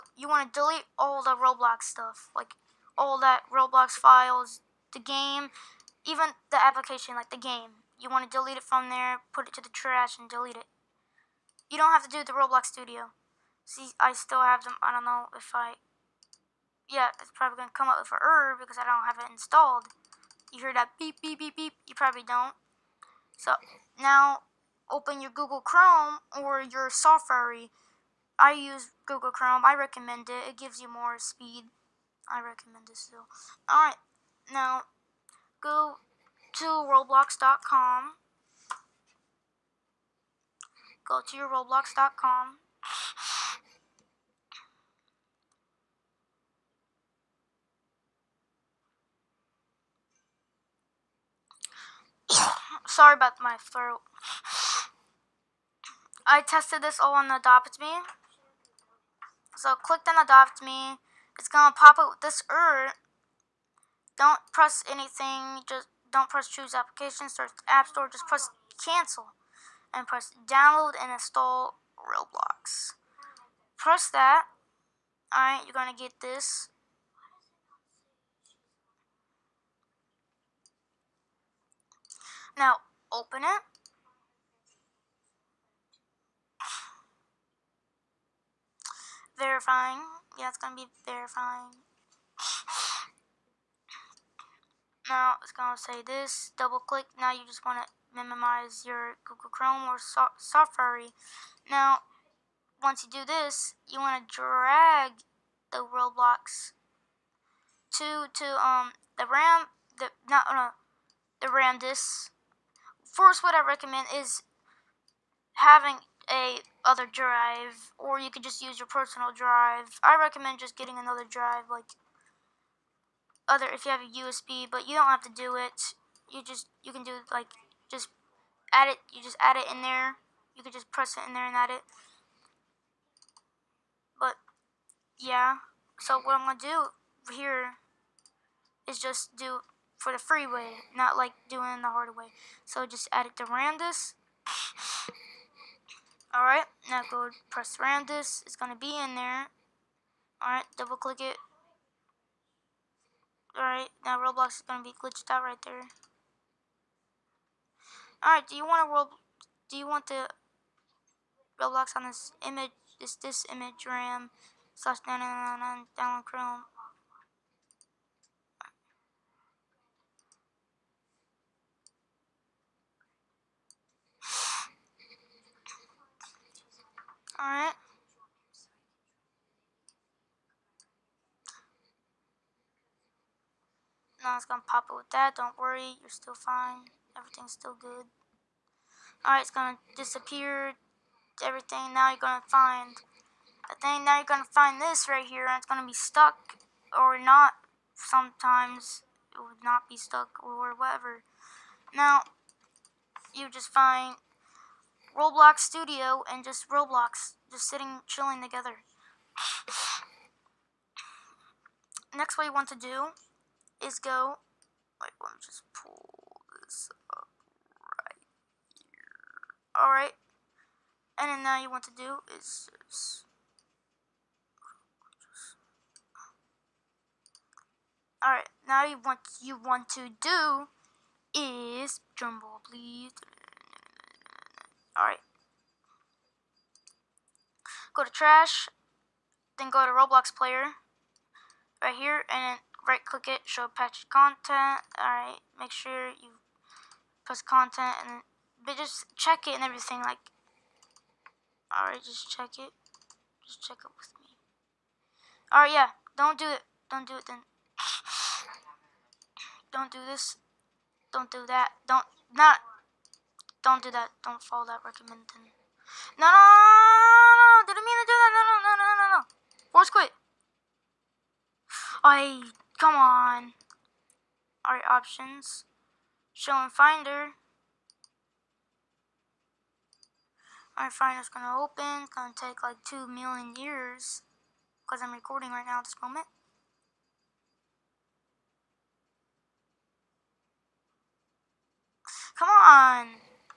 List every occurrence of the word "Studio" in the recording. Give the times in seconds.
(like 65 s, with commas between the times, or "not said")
12 s, 205 s.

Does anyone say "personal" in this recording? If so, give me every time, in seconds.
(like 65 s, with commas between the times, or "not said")
118 s.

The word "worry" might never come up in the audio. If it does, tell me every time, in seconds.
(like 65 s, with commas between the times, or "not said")
185 s.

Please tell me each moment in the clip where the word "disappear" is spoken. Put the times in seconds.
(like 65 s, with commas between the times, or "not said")
189 s.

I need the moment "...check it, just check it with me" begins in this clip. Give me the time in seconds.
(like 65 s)
252 s.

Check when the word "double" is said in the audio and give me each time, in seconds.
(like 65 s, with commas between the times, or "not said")
96 s, 150 s.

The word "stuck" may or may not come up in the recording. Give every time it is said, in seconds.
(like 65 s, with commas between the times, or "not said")
195 s, 199 s.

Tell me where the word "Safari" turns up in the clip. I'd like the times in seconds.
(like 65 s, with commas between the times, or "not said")
26 s, 100 s.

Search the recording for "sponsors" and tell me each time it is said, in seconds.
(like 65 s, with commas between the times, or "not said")
not said.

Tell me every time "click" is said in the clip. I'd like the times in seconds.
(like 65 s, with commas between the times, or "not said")
59 s, 96 s, 150 s, 243 s.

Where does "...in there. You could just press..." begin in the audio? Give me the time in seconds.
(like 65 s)
129 s.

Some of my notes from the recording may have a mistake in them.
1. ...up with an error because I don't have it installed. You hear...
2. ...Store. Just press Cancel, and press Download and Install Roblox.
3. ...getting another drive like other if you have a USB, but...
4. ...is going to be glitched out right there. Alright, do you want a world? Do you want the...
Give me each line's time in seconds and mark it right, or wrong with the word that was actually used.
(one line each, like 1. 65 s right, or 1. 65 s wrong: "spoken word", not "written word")
1. 17 s right
2. 67 s right
3. 120 s right
4. 154 s right.